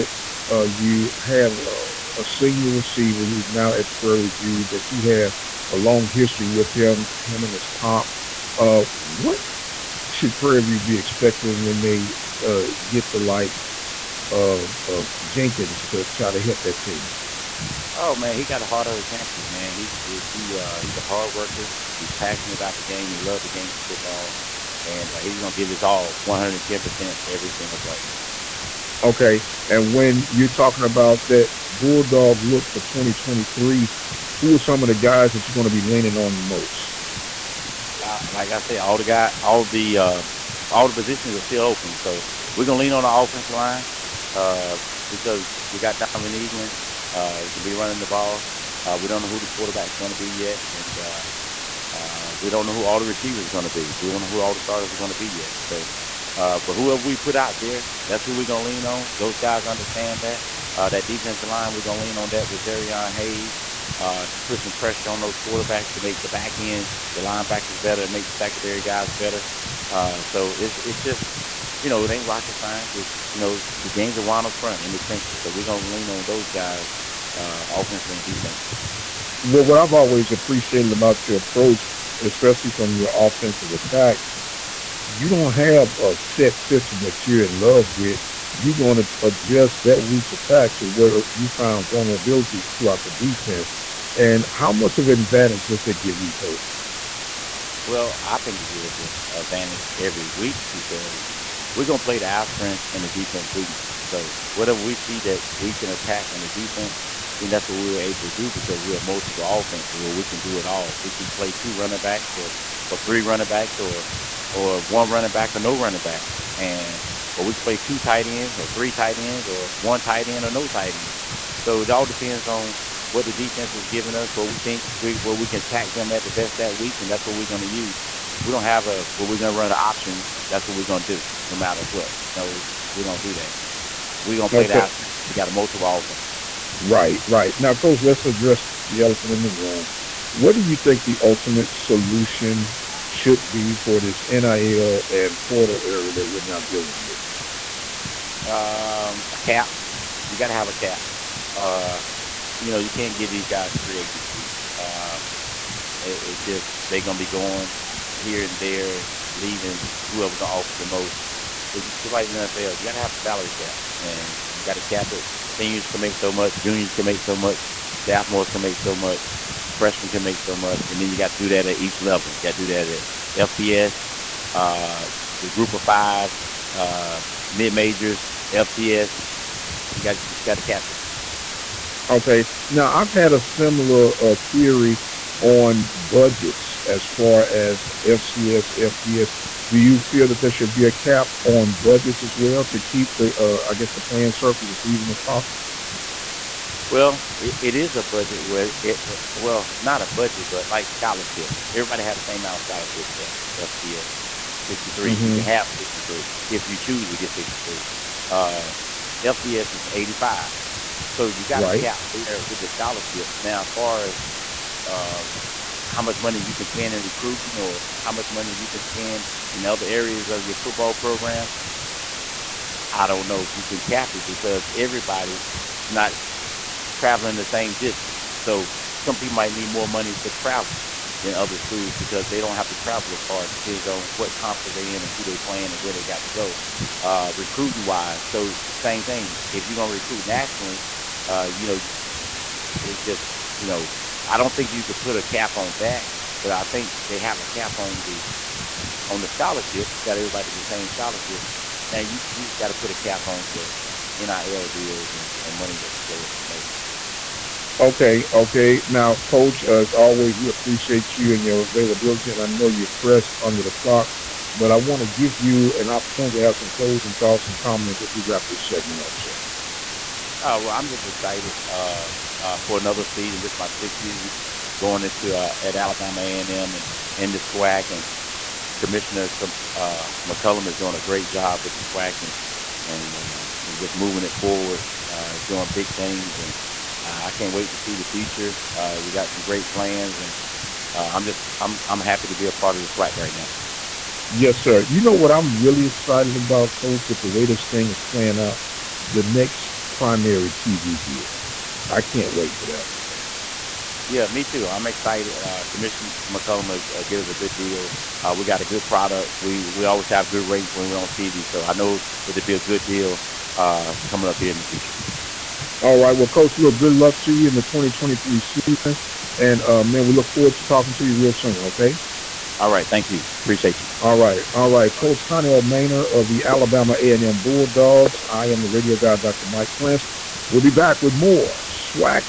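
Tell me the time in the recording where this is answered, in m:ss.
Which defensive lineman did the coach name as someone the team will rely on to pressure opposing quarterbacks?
1:02.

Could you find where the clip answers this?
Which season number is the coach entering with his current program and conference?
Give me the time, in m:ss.
4:33.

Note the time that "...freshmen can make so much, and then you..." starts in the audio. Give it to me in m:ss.
2:49.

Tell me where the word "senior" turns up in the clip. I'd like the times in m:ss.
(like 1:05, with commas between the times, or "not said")
0:02, 2:45.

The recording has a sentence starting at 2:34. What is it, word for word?
Um, it, it just they're gonna be going here and there and leaving, and whoever gonna offer the most.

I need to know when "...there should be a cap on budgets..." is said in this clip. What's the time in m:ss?
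3:10.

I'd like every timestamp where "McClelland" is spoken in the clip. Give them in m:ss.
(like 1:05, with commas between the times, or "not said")
4:40, 5:06.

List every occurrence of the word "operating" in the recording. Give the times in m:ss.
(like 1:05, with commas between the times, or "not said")
not said.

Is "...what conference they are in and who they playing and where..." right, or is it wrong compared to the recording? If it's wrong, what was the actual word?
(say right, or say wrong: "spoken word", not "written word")
right.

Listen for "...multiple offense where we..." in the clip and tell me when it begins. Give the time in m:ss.
1:49.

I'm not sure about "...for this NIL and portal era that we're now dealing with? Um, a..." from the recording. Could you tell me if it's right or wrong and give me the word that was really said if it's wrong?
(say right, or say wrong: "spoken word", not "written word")
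right.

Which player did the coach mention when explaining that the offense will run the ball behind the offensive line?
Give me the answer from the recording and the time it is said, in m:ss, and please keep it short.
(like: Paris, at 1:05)
Donovan Eaglin, at 0:46.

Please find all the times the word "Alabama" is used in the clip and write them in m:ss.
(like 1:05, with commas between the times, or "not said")
4:35, 5:26.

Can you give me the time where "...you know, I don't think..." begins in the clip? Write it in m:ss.
4:03.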